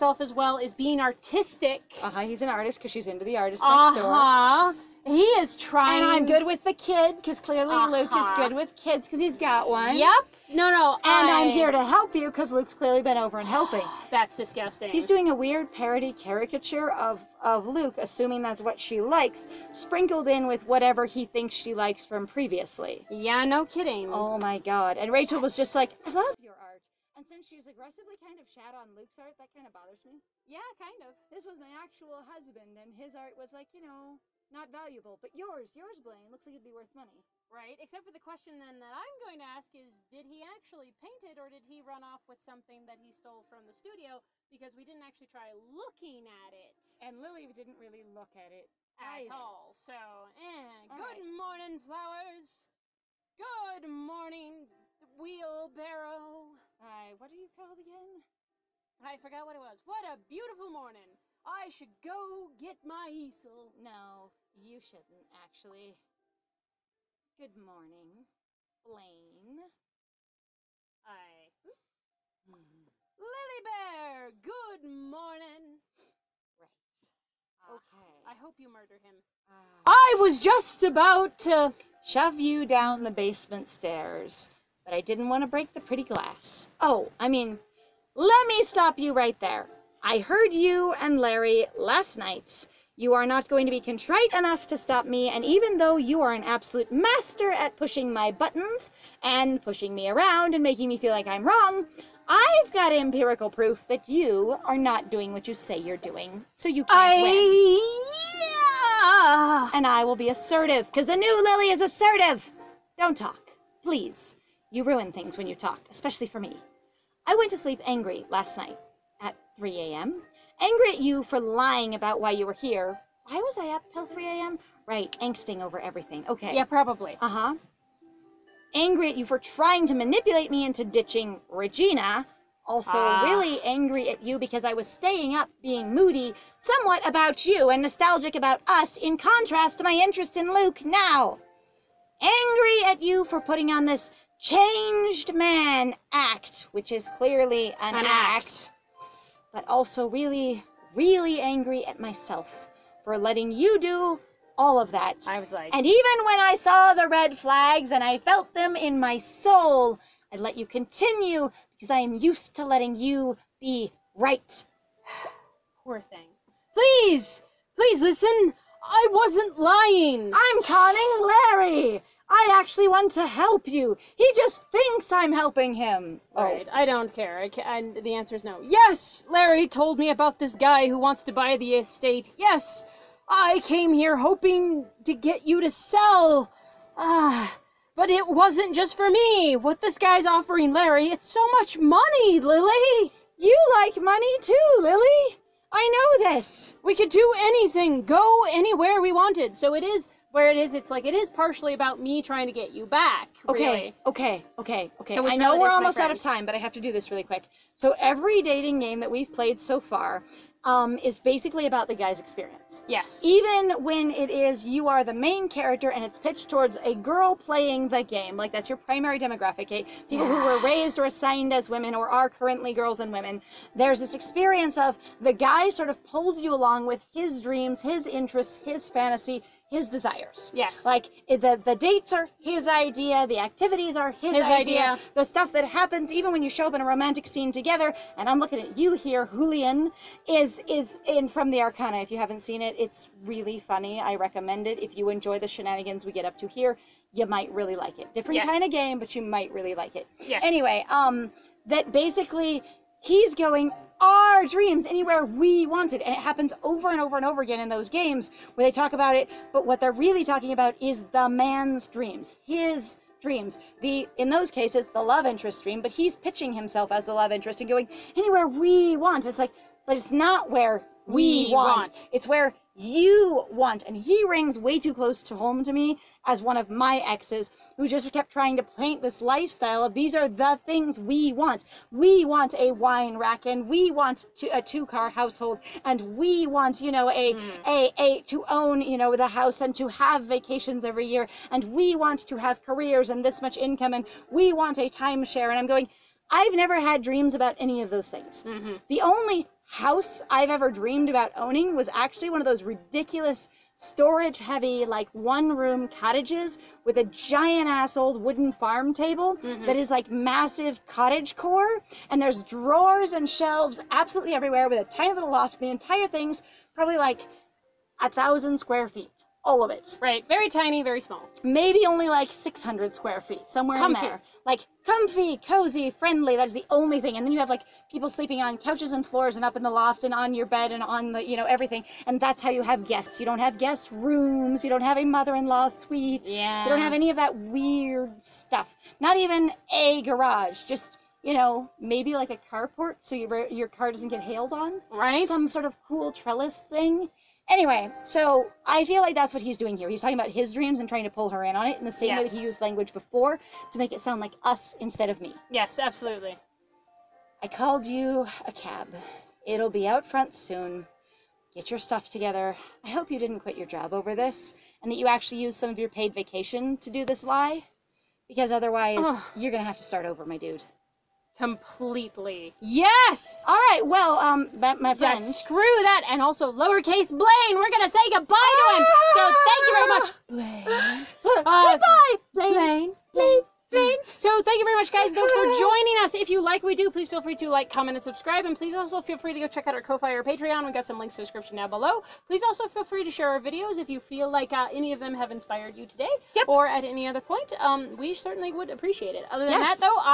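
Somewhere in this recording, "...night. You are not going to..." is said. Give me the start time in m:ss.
1:32.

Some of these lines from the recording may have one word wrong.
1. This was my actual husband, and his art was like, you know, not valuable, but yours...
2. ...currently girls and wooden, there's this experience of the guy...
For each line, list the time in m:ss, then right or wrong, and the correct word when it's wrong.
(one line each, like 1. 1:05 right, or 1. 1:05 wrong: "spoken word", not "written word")
1. 0:31 right
2. 3:42 wrong: "women", not "wooden".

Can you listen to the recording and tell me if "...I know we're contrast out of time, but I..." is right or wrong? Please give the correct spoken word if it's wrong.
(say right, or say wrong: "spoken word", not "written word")
wrong: "almost", not "contrast".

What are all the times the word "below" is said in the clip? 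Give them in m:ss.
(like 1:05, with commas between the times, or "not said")
6:31.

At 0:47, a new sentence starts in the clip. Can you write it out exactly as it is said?
And Lily didn't really look at it at either.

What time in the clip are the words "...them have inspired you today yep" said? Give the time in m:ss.
6:34.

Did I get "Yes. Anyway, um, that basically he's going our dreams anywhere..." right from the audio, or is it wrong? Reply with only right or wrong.
right.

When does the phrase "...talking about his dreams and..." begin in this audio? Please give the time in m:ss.
5:50.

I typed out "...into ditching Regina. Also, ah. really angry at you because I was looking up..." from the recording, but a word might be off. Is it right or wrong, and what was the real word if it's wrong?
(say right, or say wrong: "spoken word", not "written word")
wrong: "staying", not "looking".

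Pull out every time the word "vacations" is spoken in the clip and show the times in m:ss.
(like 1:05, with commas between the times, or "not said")
4:50, 6:06.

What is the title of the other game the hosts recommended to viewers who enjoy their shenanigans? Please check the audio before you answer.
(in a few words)
The Arcana.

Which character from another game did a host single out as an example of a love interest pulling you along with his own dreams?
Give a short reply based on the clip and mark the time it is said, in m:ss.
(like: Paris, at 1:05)
Julian, at 3:59.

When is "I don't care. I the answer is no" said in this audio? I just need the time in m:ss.
2:56.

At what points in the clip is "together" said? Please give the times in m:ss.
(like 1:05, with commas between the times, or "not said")
3:57, 6:02.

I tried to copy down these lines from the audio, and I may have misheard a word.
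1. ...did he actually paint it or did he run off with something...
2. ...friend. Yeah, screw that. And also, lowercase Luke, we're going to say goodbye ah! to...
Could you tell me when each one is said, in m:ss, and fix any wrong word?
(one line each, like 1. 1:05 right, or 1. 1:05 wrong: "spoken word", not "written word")
1. 0:40 right
2. 6:14 wrong: "Blaine", not "Luke".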